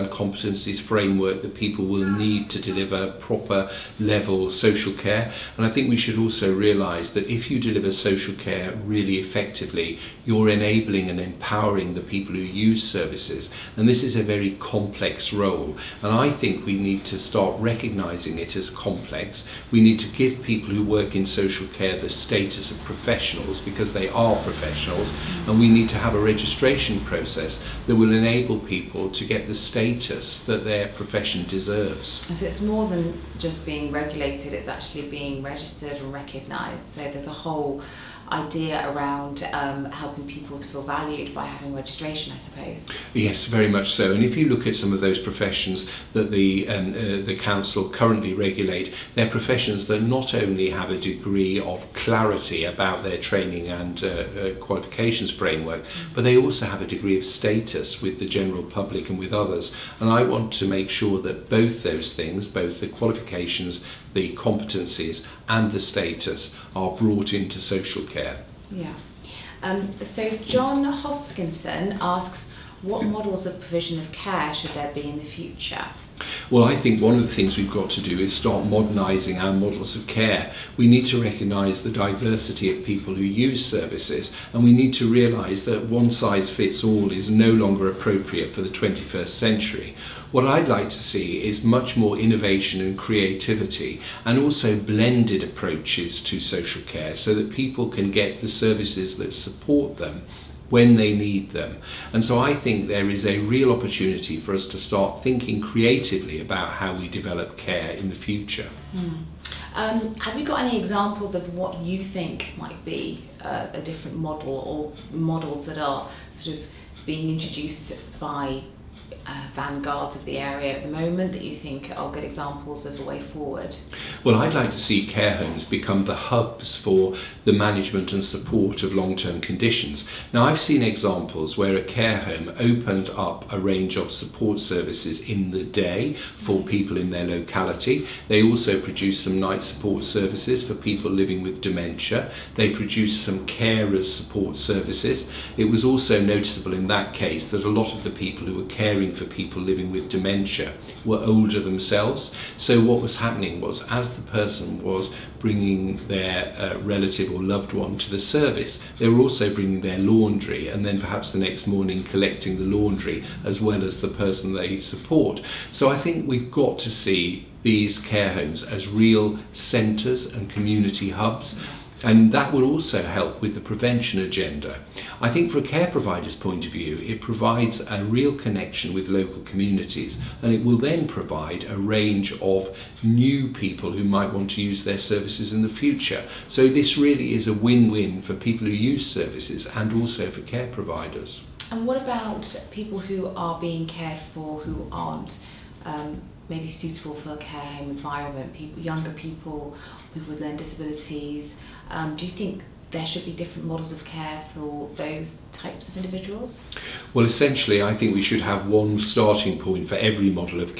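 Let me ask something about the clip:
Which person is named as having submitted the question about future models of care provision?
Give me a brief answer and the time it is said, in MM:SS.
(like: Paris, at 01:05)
John Hoskinson, at 01:10.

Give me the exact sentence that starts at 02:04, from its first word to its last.
Well, I'd like to see care homes become the hubs for the management and support of long term conditions.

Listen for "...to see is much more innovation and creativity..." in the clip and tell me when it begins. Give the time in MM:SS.
01:30.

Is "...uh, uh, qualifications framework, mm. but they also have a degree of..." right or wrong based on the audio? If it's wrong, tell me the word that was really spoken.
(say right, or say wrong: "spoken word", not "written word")
right.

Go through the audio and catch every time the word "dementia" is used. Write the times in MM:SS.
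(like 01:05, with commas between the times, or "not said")
02:21, 02:30.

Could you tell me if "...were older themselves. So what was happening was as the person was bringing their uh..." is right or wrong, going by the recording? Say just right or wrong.
right.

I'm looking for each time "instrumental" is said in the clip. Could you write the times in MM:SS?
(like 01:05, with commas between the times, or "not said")
not said.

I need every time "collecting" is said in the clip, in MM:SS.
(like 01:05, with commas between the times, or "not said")
02:42.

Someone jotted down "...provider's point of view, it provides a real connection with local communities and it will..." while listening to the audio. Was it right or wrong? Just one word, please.
right.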